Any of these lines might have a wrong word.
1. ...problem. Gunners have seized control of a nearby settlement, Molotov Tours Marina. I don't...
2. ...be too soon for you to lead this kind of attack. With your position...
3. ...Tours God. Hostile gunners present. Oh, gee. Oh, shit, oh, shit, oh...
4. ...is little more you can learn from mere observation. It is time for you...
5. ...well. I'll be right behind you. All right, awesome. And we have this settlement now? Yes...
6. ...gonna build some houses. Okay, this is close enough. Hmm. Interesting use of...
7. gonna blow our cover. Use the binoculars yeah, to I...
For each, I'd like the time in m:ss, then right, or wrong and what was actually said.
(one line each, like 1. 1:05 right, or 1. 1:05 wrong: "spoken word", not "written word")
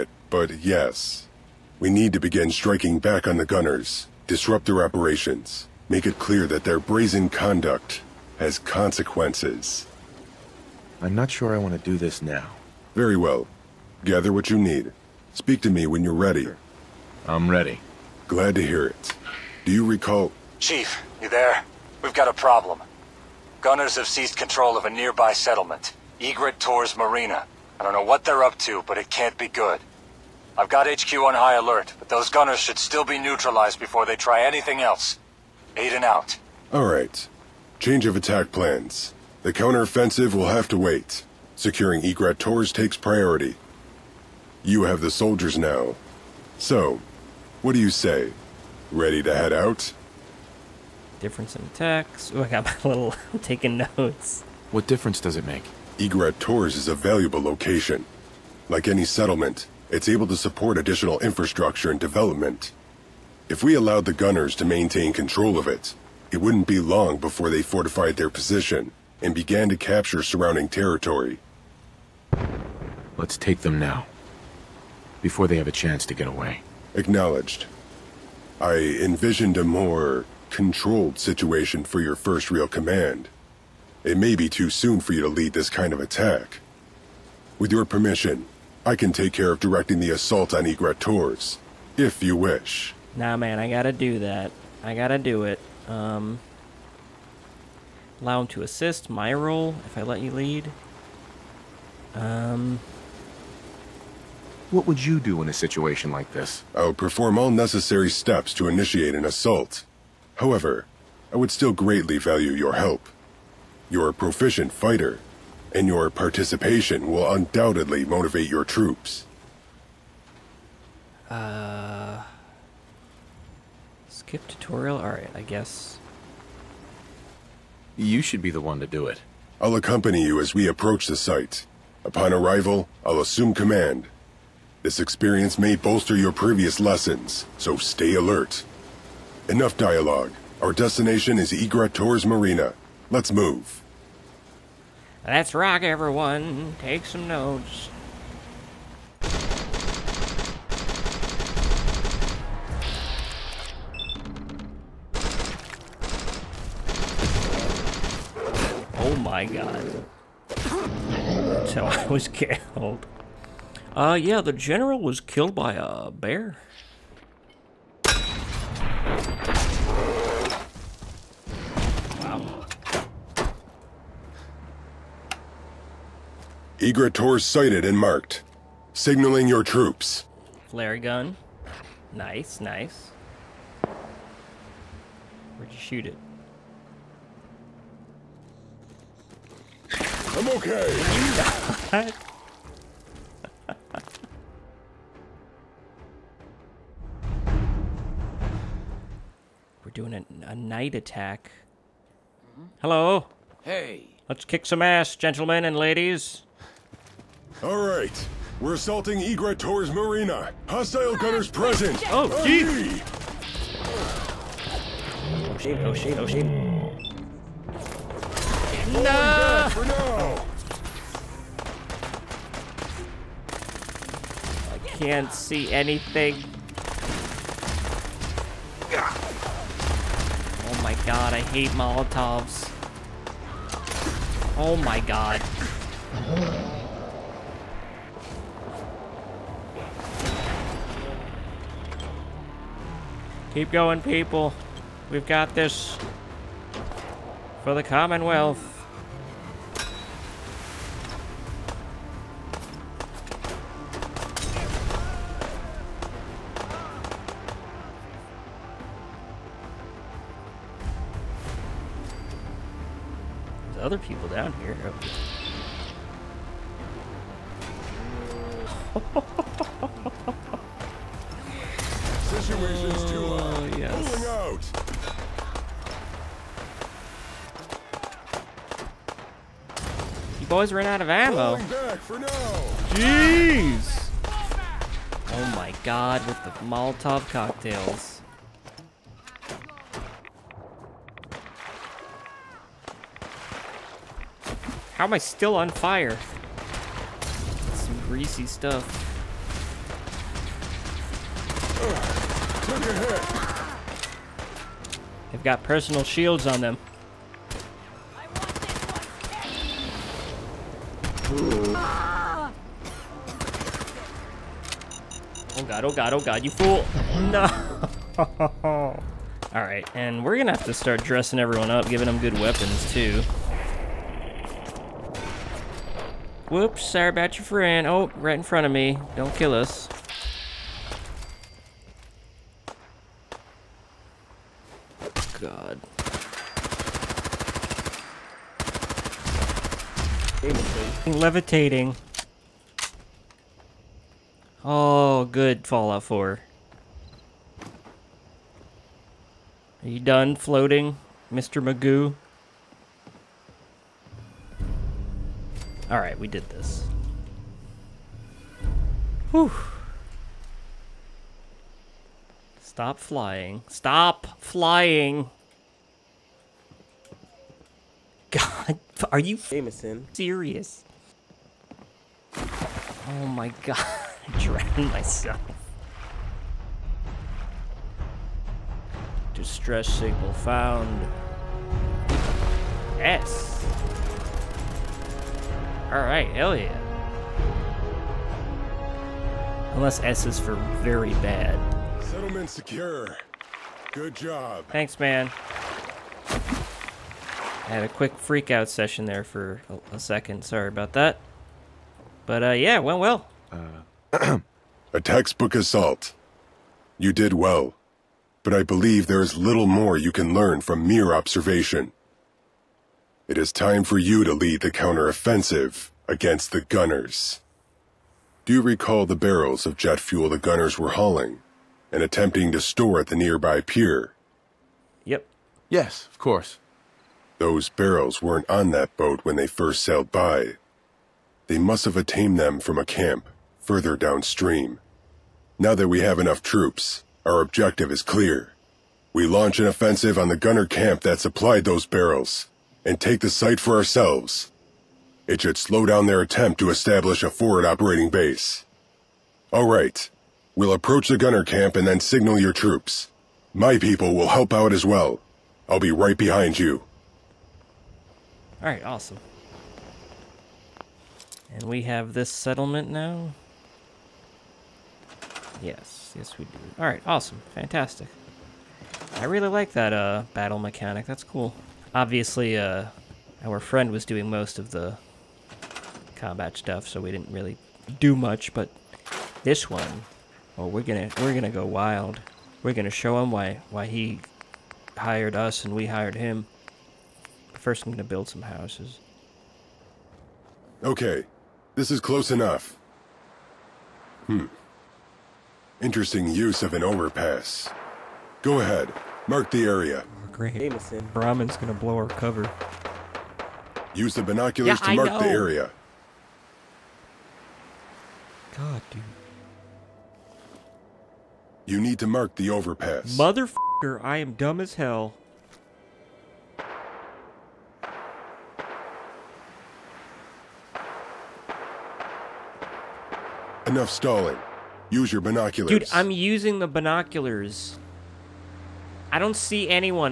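1. 0:22 wrong: "Egret", not "Molotov"
2. 1:24 wrong: "permission", not "position"
3. 3:29 wrong: "Marina", not "God"
4. 6:49 right
5. 7:34 right
6. 8:07 right
7. 8:21 right.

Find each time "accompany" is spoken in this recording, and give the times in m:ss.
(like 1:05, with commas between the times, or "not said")
2:09.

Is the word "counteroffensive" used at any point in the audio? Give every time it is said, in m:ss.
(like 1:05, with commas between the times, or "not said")
0:39, 6:54.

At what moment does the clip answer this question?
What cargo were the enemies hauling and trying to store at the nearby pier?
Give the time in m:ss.
6:59.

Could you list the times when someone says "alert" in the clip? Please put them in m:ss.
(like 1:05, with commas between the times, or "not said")
0:31, 2:18.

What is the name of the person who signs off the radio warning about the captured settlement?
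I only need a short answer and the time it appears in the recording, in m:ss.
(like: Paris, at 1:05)
Aiden, at 0:35.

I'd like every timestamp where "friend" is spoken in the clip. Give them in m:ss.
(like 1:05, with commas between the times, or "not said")
5:27, 7:53.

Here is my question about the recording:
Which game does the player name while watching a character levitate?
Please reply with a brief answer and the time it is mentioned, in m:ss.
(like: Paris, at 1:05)
Fallout 4, at 5:45.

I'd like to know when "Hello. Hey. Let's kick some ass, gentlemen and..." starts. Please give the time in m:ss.
3:22.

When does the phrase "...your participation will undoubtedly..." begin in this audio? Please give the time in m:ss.
1:55.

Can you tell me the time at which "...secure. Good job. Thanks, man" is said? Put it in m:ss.
6:32.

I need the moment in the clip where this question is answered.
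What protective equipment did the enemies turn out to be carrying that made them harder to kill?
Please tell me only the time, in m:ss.
5:05.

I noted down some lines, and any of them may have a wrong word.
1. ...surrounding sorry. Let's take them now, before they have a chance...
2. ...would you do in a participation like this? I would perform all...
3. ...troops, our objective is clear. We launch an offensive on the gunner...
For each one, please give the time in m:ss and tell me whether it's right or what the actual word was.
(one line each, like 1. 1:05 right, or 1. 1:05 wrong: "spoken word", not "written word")
1. 1:10 wrong: "territory", not "sorry"
2. 1:44 wrong: "situation", not "participation"
3. 7:16 right.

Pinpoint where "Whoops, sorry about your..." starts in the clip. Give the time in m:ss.
5:26.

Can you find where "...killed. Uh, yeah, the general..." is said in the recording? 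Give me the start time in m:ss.
2:42.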